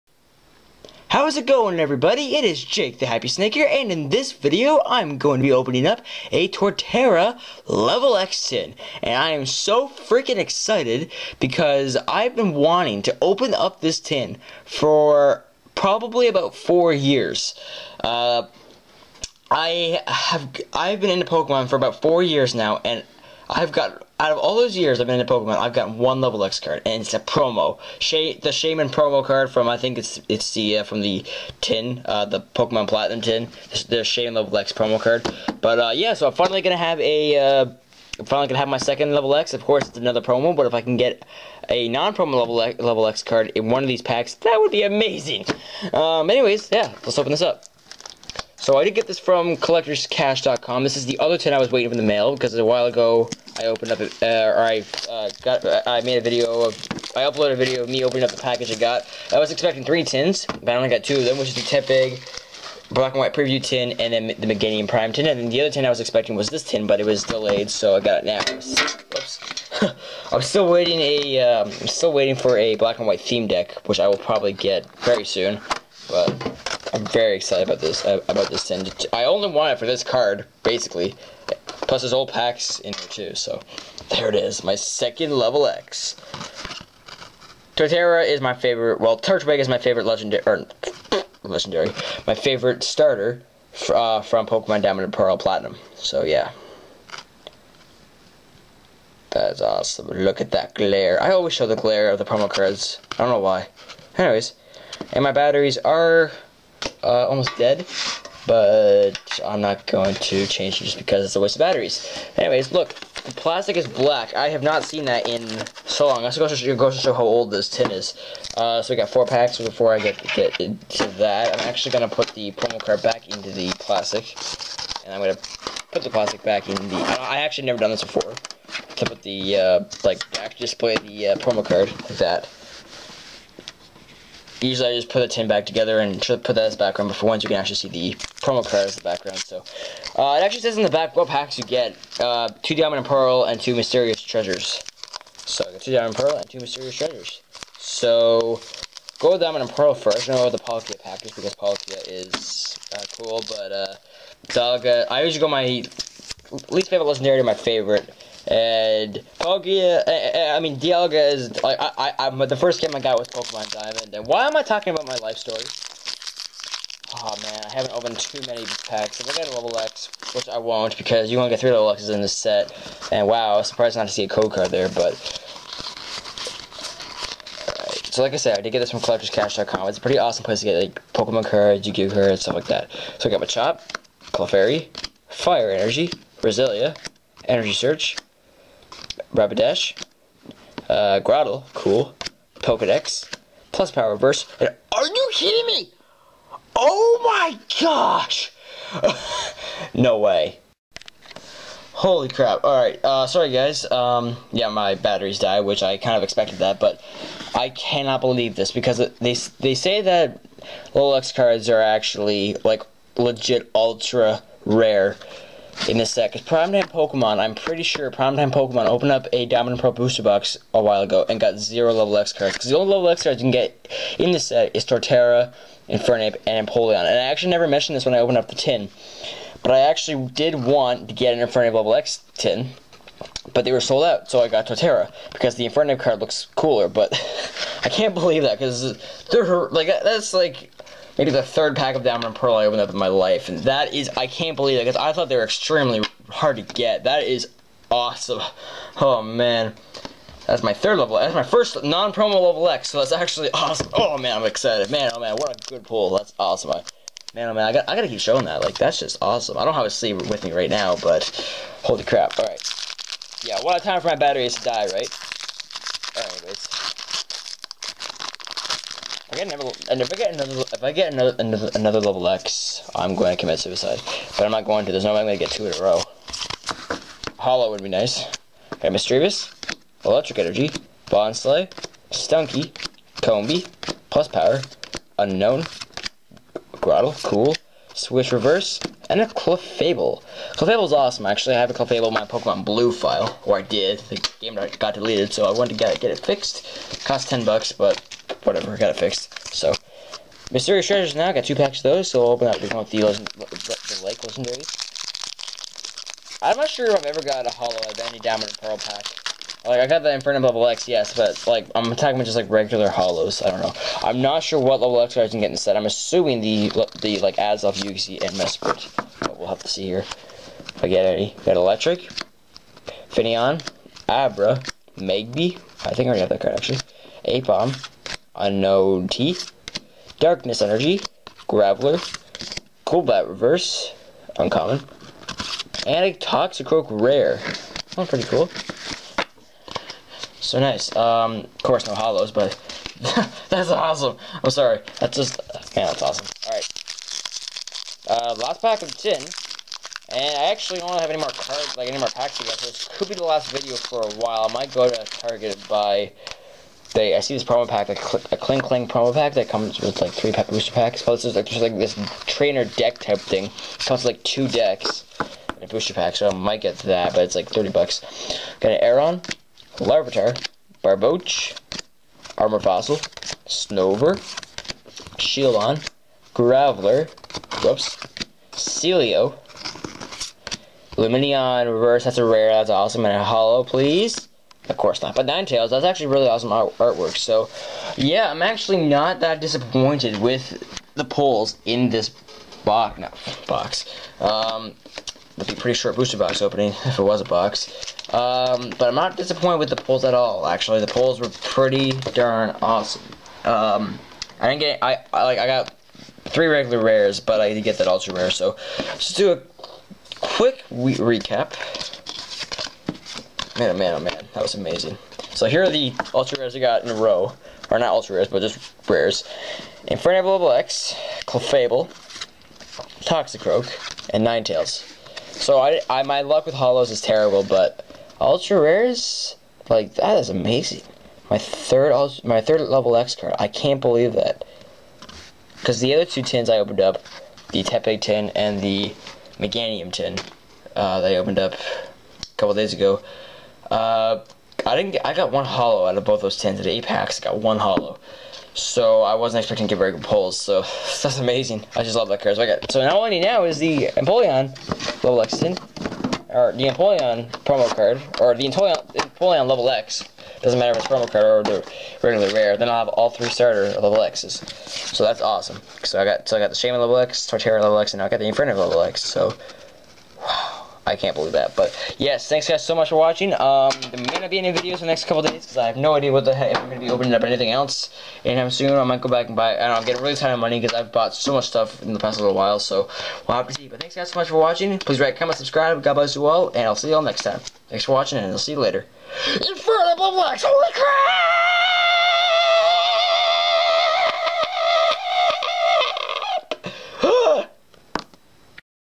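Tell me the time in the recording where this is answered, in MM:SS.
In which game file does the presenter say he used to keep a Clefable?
04:52.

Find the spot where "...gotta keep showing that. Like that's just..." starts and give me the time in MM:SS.
04:17.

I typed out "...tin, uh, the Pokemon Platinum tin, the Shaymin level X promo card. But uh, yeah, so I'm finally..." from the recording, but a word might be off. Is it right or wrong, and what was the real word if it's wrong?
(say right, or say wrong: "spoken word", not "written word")
right.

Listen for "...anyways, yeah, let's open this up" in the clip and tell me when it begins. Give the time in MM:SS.
00:46.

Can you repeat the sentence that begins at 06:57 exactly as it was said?
Or not ultra rares, but just rares.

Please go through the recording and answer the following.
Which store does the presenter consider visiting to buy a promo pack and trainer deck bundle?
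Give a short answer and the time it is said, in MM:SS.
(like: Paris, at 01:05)
Target, at 05:55.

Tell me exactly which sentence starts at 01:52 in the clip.
Anyways, look, the plastic is black.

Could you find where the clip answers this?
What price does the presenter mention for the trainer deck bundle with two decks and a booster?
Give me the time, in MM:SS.
06:07.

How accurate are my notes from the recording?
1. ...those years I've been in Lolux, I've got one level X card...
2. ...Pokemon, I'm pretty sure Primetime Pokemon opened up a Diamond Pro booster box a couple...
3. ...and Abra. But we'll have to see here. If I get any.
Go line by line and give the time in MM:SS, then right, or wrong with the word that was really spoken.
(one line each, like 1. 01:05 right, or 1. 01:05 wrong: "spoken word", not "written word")
1. 00:24 wrong: "Pokemon", not "Lolux"
2. 03:36 wrong: "while", not "couple"
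3. 05:18 wrong: "Mesprit", not "Abra".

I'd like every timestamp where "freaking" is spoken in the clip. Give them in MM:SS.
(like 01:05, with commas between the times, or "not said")
00:09.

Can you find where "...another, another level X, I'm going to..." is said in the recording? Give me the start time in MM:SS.
04:31.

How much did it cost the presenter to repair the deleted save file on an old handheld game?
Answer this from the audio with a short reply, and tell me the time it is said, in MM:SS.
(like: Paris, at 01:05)
10 bucks, at 04:57.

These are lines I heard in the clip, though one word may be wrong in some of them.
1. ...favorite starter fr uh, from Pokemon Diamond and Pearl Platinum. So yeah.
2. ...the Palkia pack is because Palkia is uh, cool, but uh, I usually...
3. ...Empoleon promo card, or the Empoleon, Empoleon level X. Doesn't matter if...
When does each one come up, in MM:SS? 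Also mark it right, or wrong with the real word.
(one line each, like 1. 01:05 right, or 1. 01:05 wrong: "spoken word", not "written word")
1. 01:32 right
2. 02:30 right
3. 07:36 right.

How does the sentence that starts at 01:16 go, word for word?
But I'm very excited about this uh, about this tin.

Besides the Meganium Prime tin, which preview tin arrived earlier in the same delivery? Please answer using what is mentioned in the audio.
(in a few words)
Tepig Black and White preview tin.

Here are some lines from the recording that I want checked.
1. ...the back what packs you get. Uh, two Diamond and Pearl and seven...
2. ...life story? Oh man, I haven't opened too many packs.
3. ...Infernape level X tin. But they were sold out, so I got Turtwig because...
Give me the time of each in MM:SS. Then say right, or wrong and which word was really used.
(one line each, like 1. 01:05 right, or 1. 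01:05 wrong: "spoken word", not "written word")
1. 02:20 wrong: "two", not "seven"
2. 02:45 right
3. 03:51 wrong: "Torterra", not "Turtwig".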